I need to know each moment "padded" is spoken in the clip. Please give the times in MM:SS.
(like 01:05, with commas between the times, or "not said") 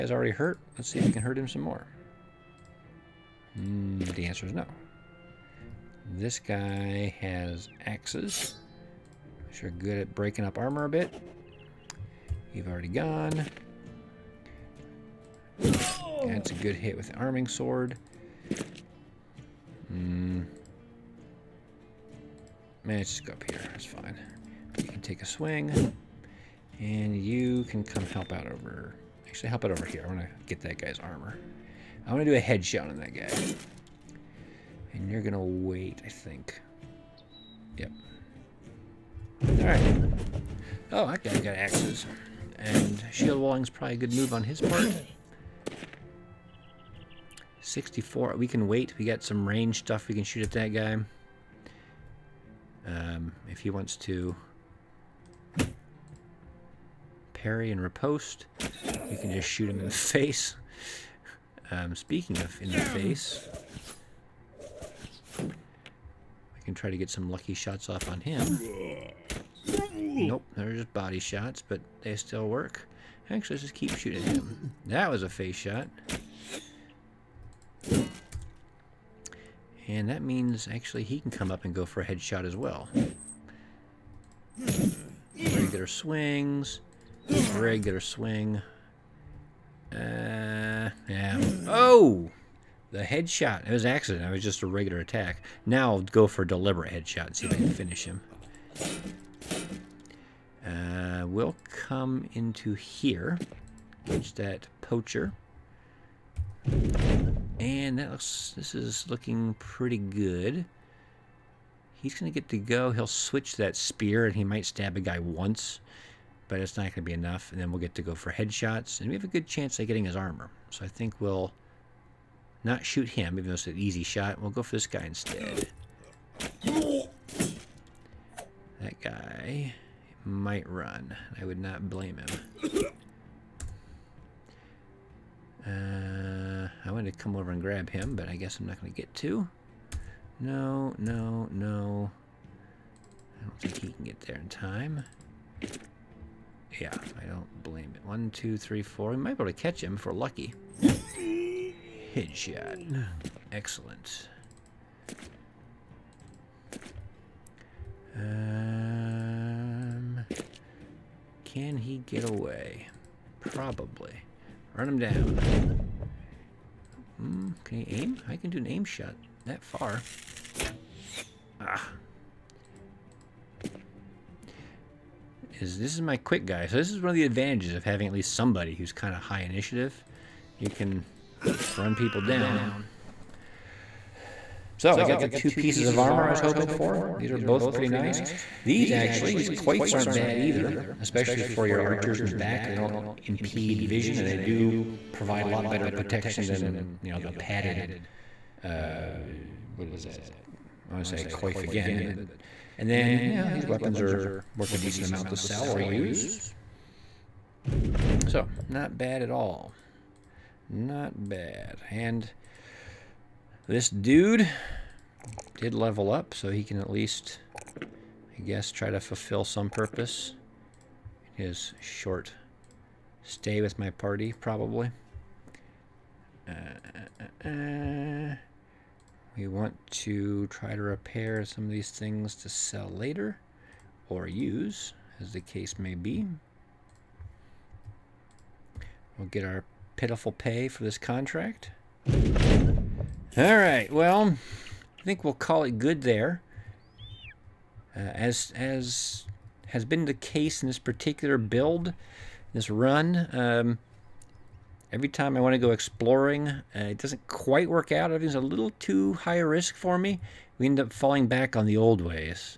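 03:17.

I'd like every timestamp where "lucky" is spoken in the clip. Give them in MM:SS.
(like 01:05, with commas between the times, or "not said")
01:07, 02:30.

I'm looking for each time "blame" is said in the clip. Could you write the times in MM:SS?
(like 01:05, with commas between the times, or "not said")
02:11, 02:27.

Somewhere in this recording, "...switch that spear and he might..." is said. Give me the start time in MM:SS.
01:53.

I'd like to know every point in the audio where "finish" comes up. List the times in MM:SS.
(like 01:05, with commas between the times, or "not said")
01:37.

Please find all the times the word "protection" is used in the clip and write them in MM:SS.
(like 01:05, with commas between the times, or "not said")
03:15.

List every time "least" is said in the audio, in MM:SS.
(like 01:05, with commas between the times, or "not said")
02:58, 03:36.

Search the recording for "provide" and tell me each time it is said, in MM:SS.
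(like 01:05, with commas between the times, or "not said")
03:15.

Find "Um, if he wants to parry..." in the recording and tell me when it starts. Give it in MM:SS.
00:52.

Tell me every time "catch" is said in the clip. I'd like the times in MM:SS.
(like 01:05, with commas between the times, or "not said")
01:44, 02:29.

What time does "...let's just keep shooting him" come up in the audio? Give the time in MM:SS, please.
01:13.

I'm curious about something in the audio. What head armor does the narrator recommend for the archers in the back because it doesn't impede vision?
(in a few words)
Coifs.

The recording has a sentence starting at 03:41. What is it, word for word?
His short stay with my party, probably.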